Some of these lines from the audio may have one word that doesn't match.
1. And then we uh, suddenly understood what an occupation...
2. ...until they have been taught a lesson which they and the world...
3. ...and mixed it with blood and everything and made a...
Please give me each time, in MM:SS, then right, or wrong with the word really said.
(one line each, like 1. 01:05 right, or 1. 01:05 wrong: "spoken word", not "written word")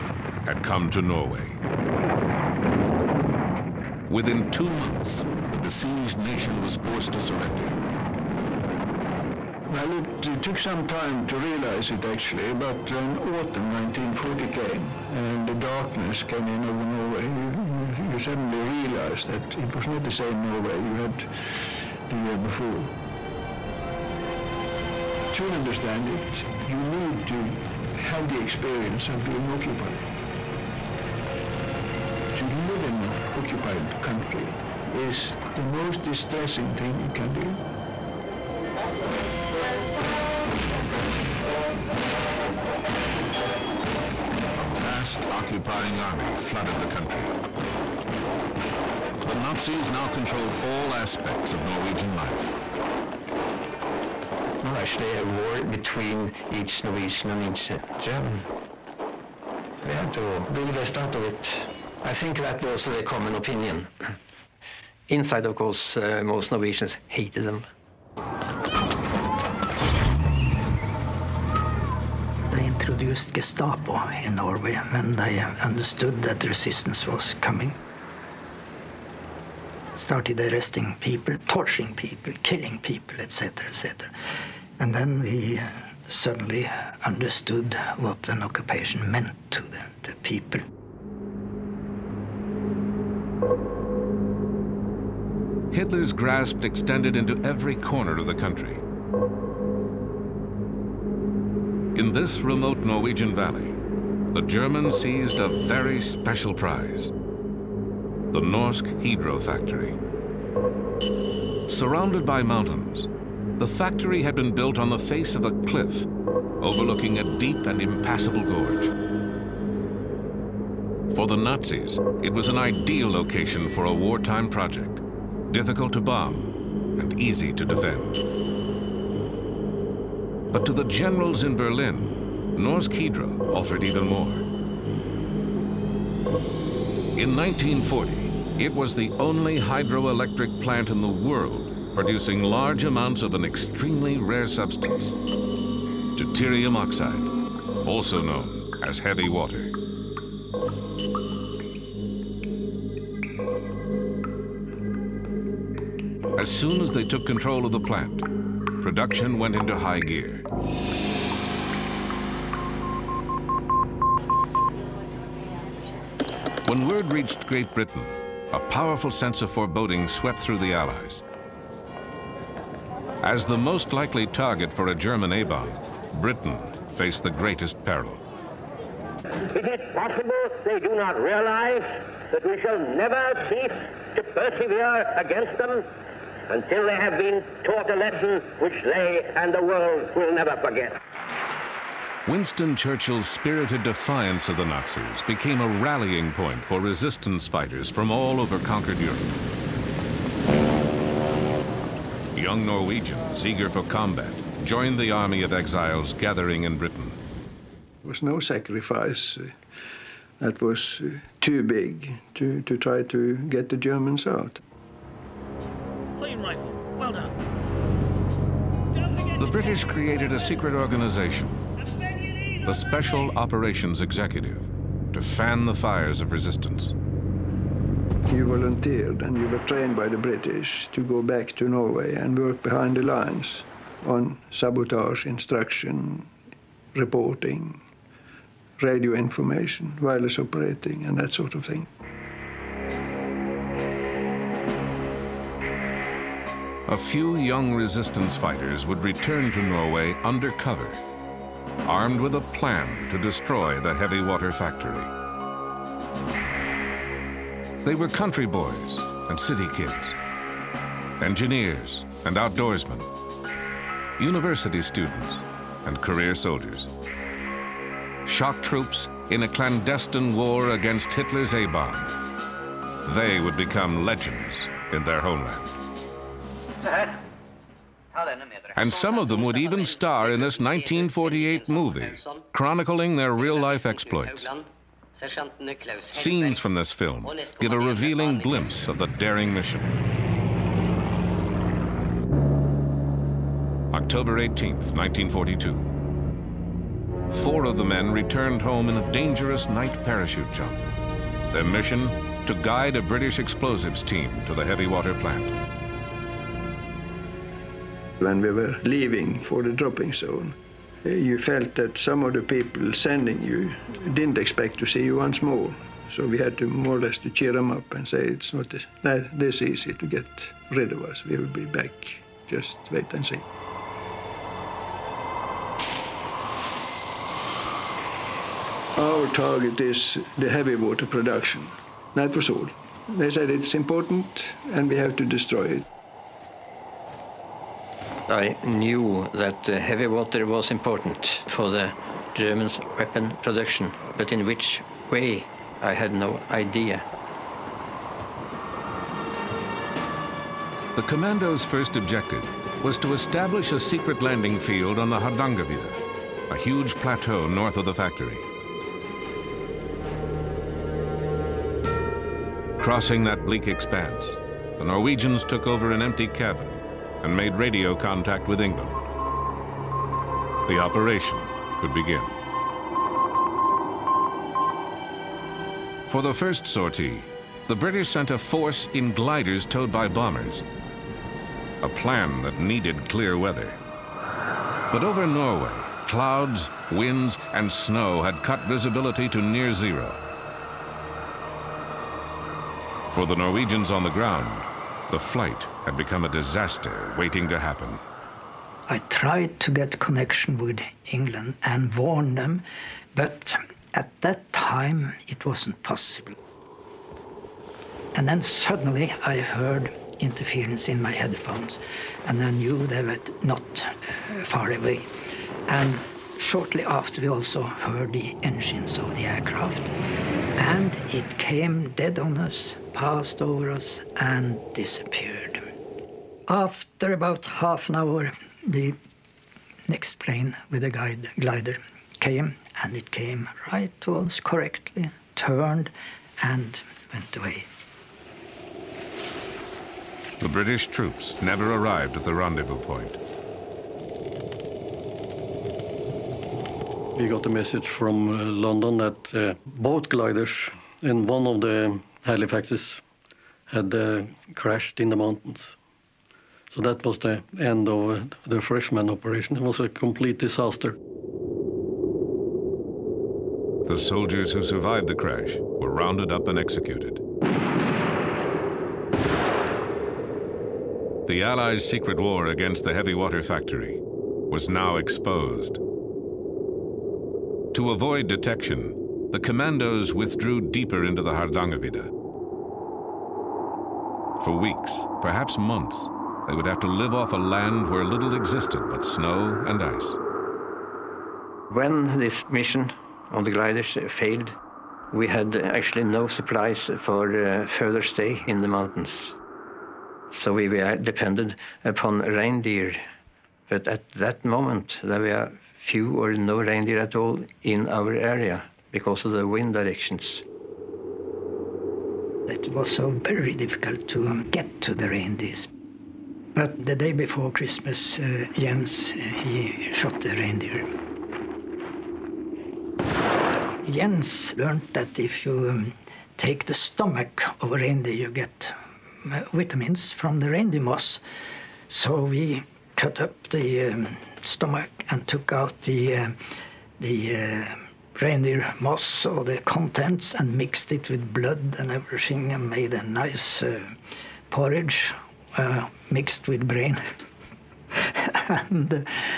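1. 01:24 right
2. 03:06 right
3. 09:00 right.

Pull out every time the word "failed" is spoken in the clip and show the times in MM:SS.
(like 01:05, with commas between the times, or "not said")
08:14.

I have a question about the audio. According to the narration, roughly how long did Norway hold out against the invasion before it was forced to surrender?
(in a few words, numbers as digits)
2 months.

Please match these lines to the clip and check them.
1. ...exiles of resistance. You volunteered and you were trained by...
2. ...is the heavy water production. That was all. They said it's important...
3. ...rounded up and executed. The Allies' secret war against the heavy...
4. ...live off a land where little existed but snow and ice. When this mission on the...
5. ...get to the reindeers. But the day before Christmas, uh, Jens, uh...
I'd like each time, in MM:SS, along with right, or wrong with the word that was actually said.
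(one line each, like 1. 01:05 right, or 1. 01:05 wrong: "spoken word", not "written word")
1. 03:45 wrong: "fires", not "exiles"
2. 05:29 right
3. 07:45 right
4. 08:06 right
5. 08:34 right.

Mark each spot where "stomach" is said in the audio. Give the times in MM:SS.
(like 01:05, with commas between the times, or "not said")
08:46, 08:54.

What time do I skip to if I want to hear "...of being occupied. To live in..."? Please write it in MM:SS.
00:29.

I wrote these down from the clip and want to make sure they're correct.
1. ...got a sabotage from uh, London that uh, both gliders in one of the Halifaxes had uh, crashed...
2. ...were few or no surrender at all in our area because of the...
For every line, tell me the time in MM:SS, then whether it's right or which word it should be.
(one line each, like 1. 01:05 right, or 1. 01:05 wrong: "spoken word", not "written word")
1. 07:27 wrong: "message", not "sabotage"
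2. 08:25 wrong: "reindeer", not "surrender".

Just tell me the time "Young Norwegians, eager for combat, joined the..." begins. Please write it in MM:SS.
03:22.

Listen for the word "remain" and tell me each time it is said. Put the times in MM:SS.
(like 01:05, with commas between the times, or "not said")
not said.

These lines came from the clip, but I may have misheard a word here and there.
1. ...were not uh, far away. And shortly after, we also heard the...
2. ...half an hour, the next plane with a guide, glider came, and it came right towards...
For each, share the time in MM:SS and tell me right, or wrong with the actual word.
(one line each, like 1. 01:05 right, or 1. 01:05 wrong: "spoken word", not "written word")
1. 06:53 right
2. 07:07 right.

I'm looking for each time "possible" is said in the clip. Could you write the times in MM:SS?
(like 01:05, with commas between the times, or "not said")
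02:59, 06:45.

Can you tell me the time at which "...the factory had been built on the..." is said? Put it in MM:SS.
01:53.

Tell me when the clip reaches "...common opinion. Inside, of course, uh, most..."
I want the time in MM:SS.
01:03.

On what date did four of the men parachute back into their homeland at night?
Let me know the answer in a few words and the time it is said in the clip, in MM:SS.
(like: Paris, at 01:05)
October 18, 1942, at 04:53.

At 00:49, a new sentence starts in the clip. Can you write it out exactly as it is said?
The Nazis now controlled all aspects of Norwegian life.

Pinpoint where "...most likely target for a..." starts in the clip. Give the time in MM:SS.
02:53.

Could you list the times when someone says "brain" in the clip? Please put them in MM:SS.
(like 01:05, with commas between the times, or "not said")
09:06.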